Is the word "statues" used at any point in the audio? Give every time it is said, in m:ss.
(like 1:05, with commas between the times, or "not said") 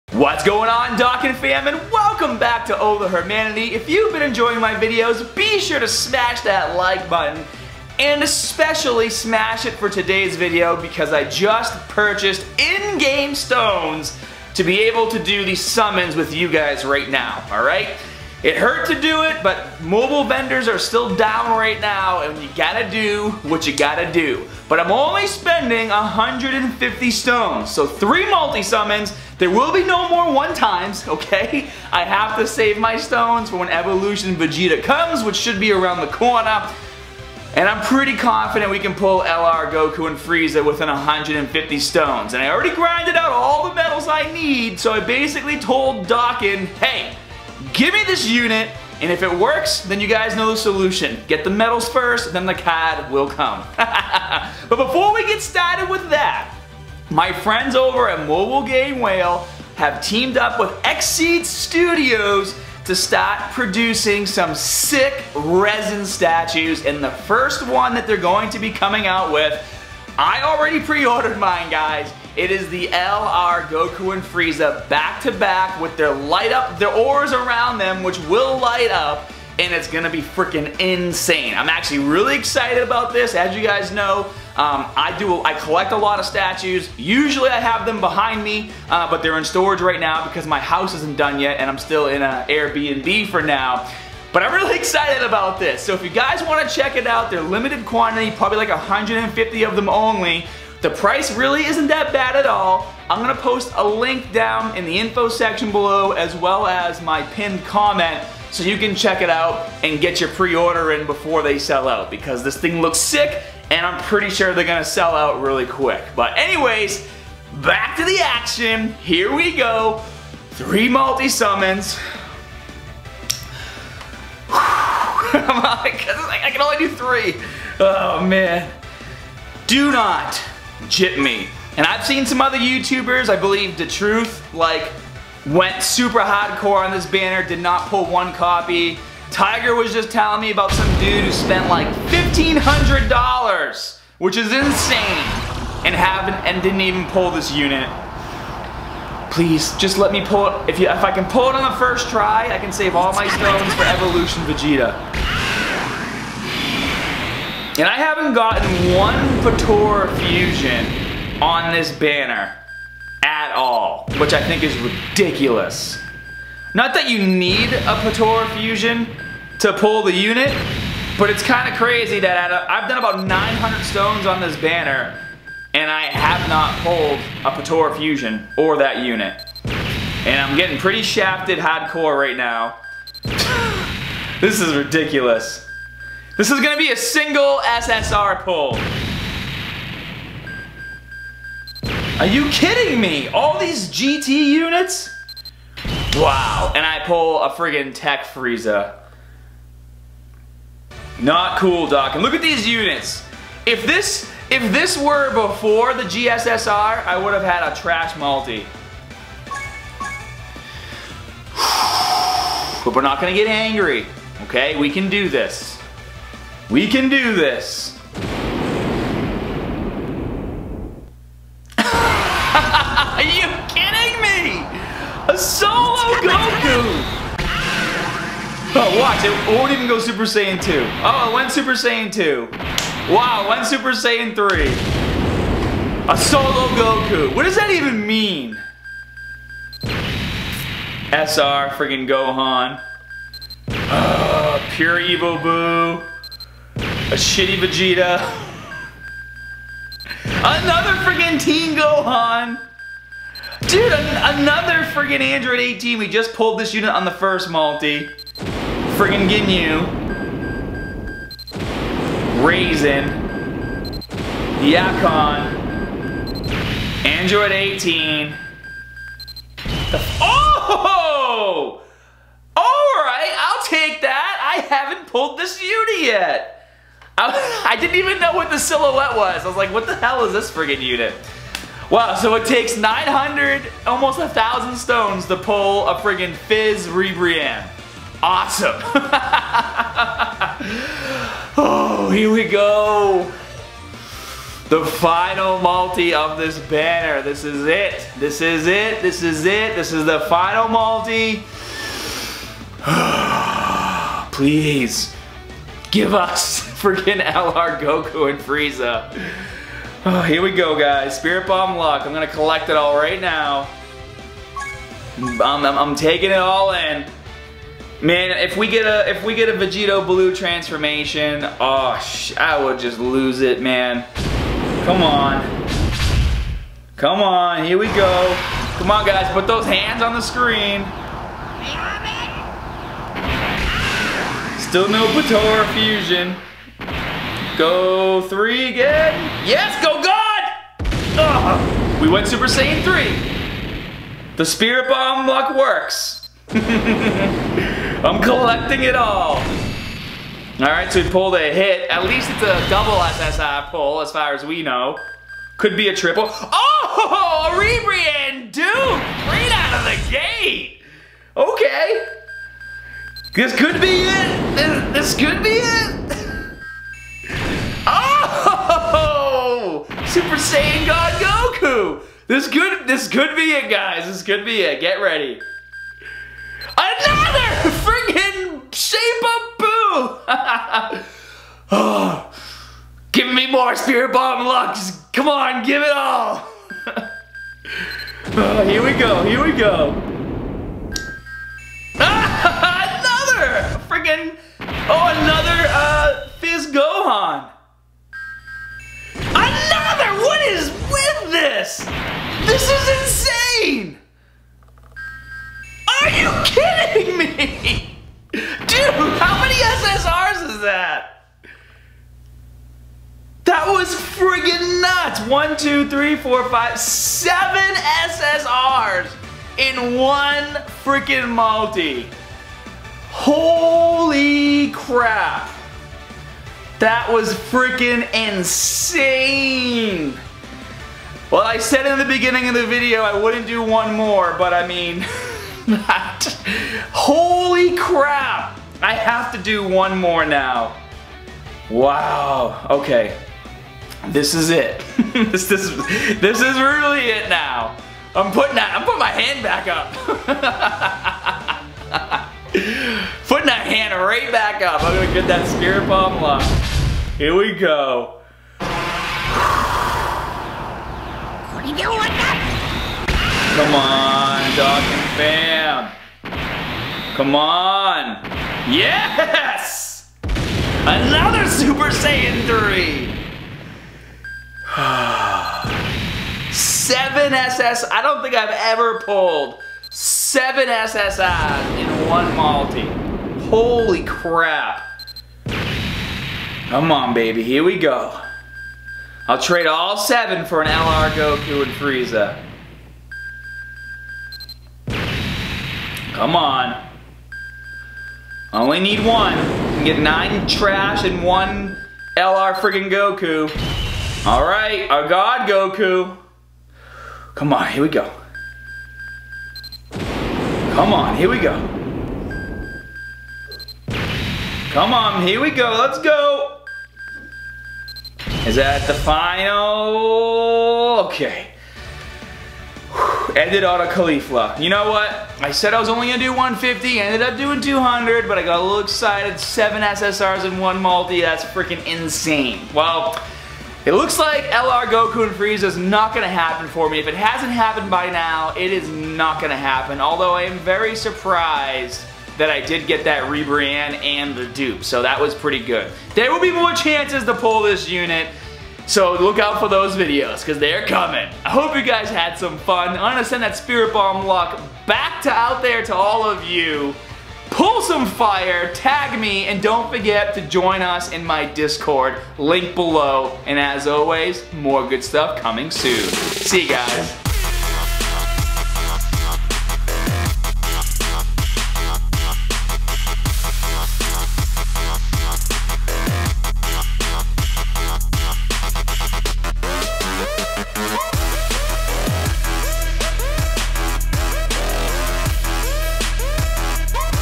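1:06, 1:26.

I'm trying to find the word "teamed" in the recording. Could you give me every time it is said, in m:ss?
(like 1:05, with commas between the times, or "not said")
1:00.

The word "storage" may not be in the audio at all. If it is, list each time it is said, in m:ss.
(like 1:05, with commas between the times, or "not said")
1:29.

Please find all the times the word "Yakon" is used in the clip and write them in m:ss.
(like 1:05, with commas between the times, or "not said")
4:24.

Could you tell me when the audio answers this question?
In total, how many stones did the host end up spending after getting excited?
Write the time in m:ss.
8:47.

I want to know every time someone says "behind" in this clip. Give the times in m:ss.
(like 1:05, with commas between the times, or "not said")
1:28.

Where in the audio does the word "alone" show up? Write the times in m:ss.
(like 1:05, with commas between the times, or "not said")
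not said.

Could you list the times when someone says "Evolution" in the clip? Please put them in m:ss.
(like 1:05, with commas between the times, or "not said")
0:33, 2:33.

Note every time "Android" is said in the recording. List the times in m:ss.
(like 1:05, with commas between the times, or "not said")
4:15, 4:27.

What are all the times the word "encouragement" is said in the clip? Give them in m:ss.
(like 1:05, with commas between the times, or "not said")
not said.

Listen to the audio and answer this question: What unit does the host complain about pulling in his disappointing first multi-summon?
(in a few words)
Tech Frieza.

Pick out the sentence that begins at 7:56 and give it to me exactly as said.
Seven SS, I don't think I've ever pulled seven SSRs in one multi.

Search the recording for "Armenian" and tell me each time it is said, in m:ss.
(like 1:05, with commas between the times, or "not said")
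not said.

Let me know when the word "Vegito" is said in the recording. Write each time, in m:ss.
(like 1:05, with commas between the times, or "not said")
5:19.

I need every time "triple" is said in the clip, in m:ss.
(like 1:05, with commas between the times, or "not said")
5:55.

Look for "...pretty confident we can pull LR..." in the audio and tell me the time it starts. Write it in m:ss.
0:37.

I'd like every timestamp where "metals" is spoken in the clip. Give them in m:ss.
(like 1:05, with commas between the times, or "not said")
0:43.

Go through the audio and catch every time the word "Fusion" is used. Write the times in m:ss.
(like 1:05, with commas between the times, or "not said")
2:40, 2:48, 2:57, 5:35.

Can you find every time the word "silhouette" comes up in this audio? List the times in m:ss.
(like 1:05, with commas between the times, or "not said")
4:38.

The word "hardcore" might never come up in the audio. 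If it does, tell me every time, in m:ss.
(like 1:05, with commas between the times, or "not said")
2:16, 3:01.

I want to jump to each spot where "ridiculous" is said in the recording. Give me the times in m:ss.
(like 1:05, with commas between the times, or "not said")
2:44, 3:04.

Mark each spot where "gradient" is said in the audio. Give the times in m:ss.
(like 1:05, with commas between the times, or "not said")
not said.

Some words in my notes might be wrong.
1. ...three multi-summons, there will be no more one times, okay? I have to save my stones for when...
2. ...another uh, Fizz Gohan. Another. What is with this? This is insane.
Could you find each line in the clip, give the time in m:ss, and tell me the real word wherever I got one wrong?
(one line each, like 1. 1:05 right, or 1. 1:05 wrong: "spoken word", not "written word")
1. 0:27 right
2. 6:35 right.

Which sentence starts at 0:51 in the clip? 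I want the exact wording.
Get the medals first, then the CAD will come.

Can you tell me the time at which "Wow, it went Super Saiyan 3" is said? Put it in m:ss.
3:53.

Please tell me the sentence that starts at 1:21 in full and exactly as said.
I'm actually really excited about this.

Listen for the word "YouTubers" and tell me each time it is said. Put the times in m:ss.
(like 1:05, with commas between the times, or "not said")
2:12.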